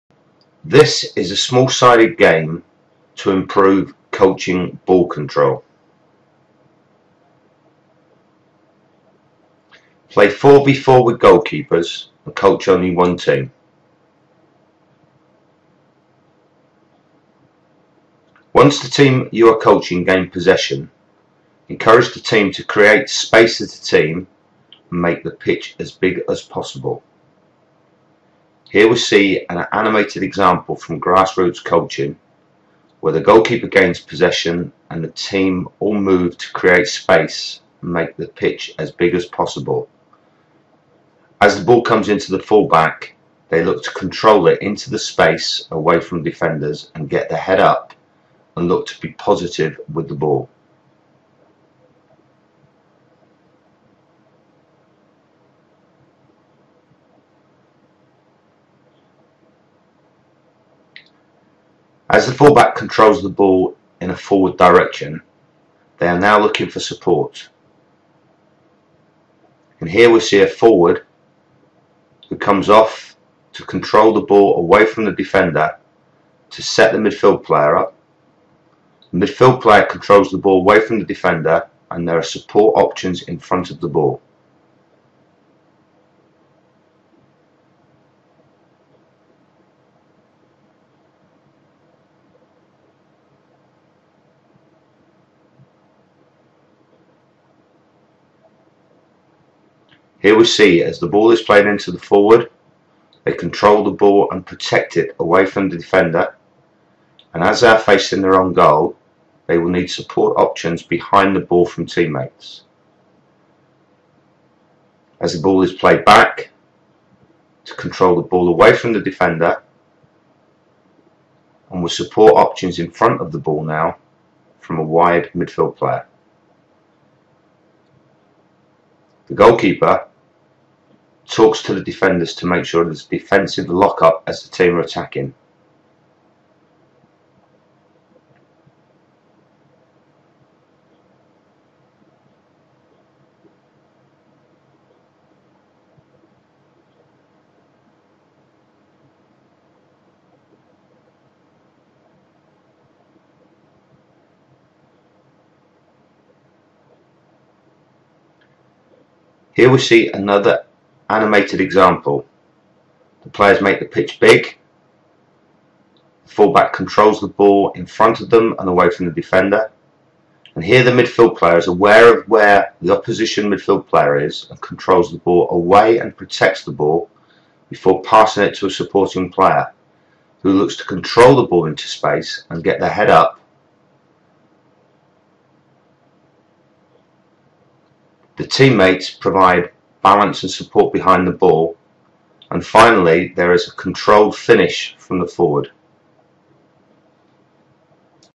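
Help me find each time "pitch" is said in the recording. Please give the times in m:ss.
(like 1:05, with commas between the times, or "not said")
0:25, 0:38, 2:43.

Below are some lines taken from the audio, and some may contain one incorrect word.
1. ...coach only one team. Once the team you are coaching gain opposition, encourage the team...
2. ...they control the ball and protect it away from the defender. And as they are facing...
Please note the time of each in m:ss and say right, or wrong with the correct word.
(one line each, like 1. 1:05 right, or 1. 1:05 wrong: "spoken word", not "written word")
1. 0:12 wrong: "possession", not "opposition"
2. 1:43 right.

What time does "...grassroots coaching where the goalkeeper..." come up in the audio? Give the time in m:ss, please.
0:31.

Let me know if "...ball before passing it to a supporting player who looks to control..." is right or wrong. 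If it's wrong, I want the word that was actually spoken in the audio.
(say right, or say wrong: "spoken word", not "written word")
right.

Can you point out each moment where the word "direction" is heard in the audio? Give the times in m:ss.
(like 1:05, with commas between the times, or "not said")
1:04.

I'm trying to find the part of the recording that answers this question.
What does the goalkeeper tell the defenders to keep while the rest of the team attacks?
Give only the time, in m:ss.
2:13.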